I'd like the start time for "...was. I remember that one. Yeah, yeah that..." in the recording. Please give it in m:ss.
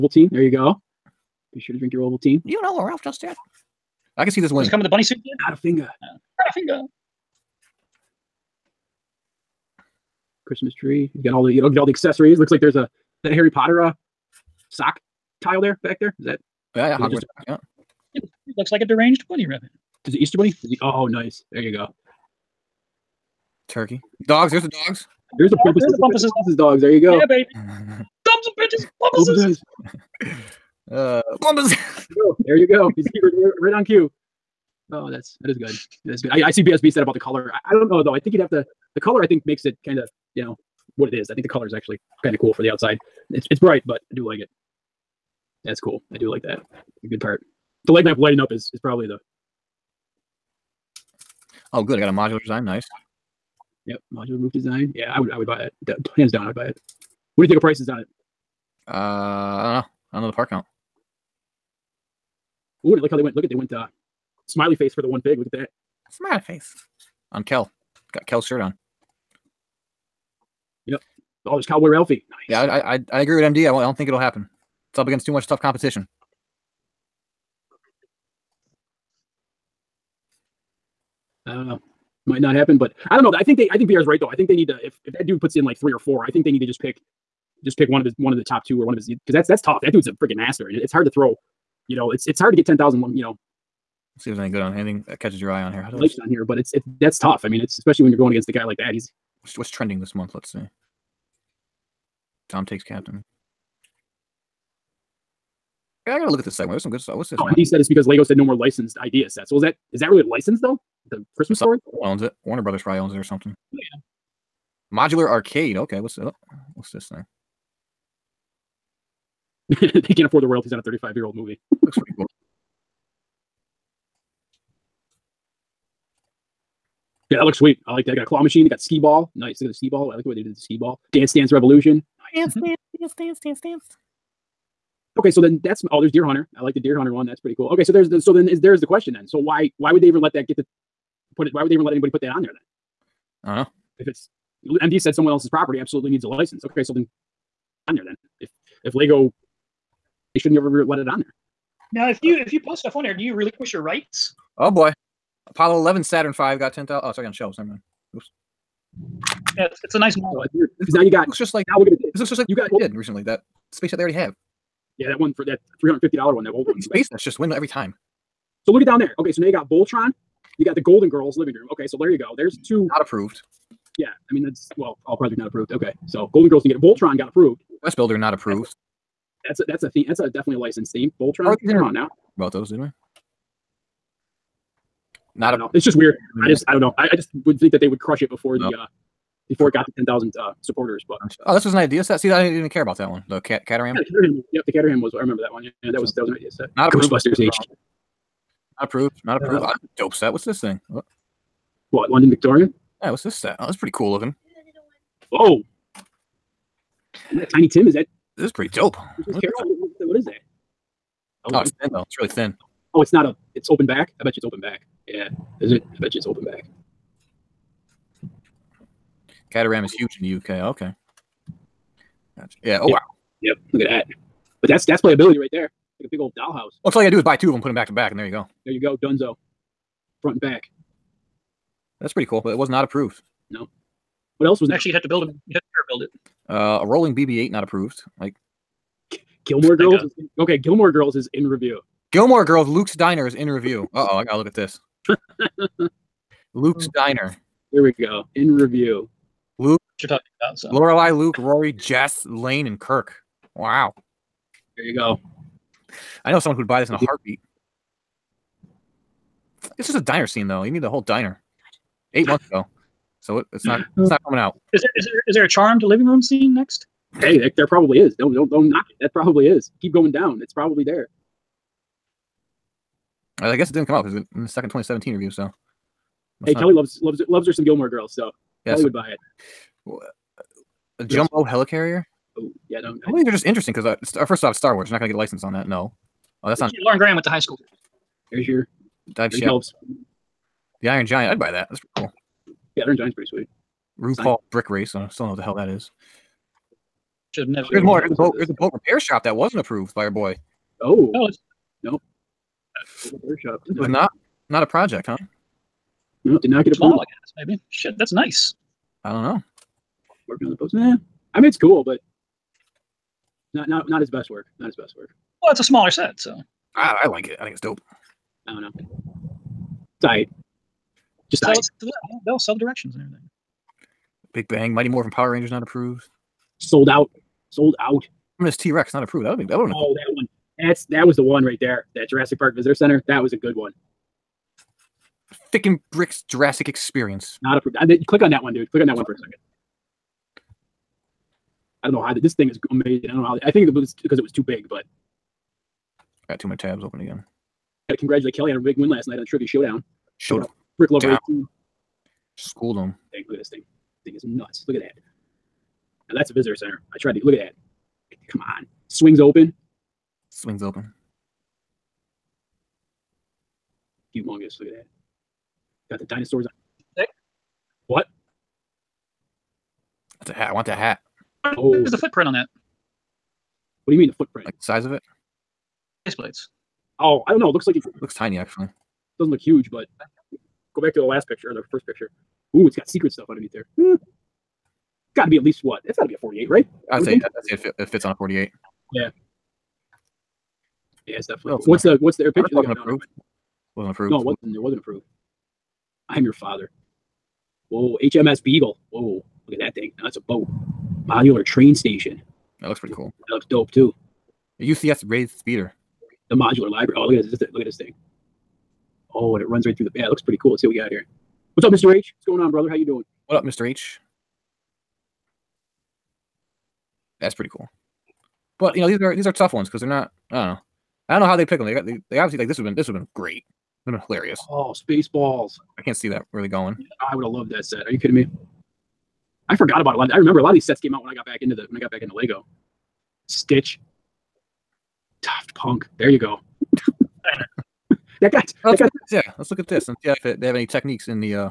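3:15.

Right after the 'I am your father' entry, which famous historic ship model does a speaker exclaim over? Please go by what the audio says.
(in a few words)
HMS Beagle.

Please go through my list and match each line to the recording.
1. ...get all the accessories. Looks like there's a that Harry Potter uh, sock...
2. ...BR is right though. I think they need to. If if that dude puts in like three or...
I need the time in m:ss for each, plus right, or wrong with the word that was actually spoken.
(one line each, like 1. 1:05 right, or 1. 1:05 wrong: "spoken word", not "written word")
1. 0:11 right
2. 1:23 right.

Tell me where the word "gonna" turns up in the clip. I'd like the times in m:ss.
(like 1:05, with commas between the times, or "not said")
2:41, 5:28.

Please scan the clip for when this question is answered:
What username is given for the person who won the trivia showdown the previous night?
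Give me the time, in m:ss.
5:50.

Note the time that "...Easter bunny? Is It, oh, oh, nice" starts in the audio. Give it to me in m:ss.
0:20.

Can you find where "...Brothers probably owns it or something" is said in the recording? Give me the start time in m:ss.
1:52.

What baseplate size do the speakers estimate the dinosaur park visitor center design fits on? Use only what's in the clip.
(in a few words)
48.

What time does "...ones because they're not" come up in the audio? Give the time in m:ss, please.
6:59.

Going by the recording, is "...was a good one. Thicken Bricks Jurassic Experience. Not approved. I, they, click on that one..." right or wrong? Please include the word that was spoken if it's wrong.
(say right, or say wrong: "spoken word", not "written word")
right.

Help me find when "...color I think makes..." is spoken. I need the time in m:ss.
0:38.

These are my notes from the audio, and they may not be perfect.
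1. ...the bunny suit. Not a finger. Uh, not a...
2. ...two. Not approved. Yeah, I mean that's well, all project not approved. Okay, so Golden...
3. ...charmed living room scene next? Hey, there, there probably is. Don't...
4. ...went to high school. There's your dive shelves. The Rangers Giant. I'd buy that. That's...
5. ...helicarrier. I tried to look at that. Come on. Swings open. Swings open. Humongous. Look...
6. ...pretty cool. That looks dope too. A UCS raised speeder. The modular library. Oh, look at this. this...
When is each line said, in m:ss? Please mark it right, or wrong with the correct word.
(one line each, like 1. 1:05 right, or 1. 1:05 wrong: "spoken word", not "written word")
1. 0:04 right
2. 2:52 right
3. 4:25 right
4. 4:47 wrong: "Iron", not "Rangers"
5. 5:56 wrong: "center", not "helicarrier"
6. 6:42 right.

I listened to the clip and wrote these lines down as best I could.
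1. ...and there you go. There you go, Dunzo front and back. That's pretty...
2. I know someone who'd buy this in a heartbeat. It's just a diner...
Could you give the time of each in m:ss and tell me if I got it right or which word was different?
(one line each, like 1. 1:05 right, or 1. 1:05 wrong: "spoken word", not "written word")
1. 3:48 right
2. 4:16 right.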